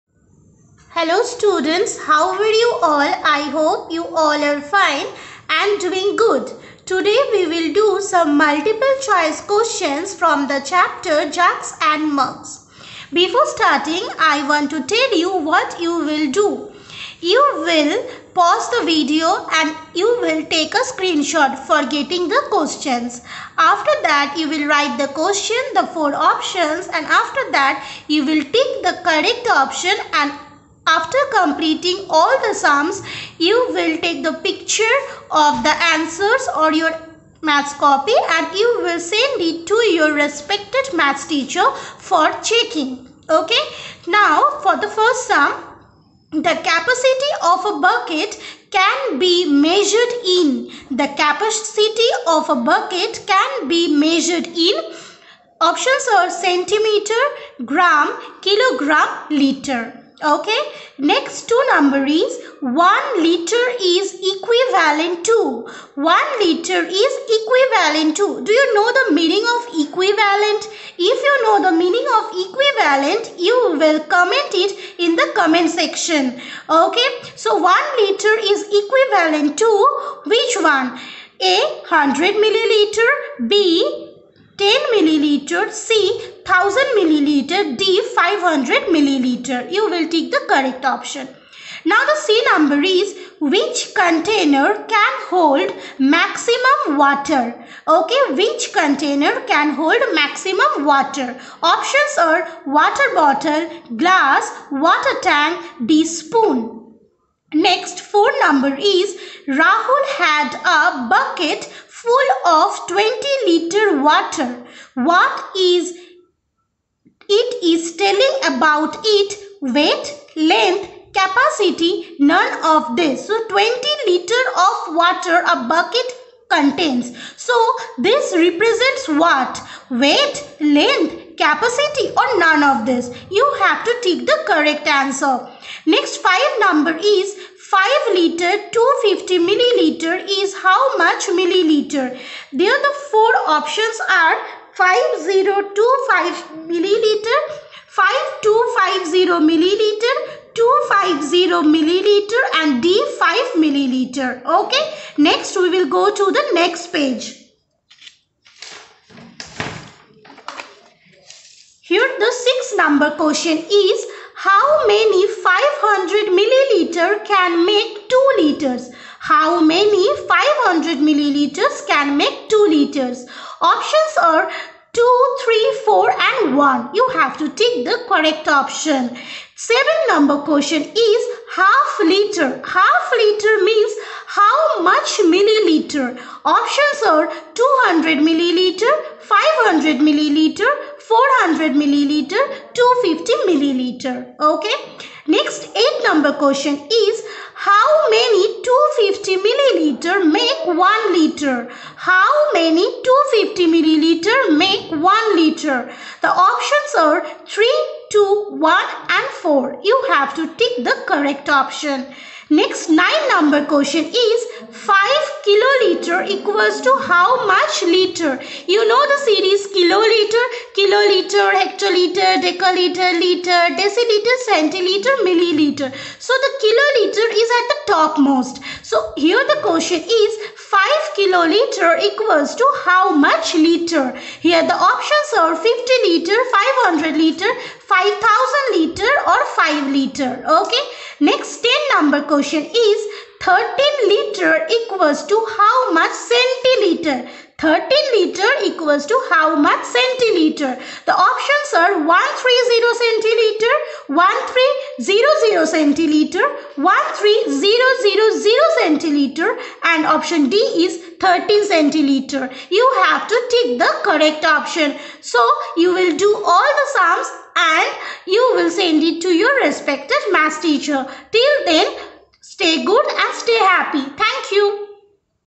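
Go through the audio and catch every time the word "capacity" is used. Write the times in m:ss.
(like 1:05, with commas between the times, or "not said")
0:46, 0:51, 2:01, 2:11.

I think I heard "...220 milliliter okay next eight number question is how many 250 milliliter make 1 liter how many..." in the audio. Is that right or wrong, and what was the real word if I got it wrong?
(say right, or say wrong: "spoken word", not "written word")
wrong: "250", not "220".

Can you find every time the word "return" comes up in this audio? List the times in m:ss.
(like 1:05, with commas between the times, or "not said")
not said.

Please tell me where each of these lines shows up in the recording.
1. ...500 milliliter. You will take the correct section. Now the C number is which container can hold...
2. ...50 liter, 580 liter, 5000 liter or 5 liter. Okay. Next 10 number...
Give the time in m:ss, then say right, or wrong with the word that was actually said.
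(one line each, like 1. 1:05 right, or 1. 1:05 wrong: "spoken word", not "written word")
1. 1:28 wrong: "option", not "section"
2. 3:55 wrong: "500", not "580".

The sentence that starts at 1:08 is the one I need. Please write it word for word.
Do you know the meaning of equivalent?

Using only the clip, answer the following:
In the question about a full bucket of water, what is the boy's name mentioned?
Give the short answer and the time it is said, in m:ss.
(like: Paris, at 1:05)
Rahul, at 1:49.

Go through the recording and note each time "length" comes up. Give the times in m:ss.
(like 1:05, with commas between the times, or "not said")
2:00, 2:10.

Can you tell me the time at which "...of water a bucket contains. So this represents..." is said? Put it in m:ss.
2:04.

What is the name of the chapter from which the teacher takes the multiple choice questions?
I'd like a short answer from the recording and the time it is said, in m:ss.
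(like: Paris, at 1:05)
Jugs and Mugs, at 0:11.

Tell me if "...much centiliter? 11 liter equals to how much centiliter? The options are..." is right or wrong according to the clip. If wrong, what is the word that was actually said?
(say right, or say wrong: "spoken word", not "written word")
wrong: "13", not "11".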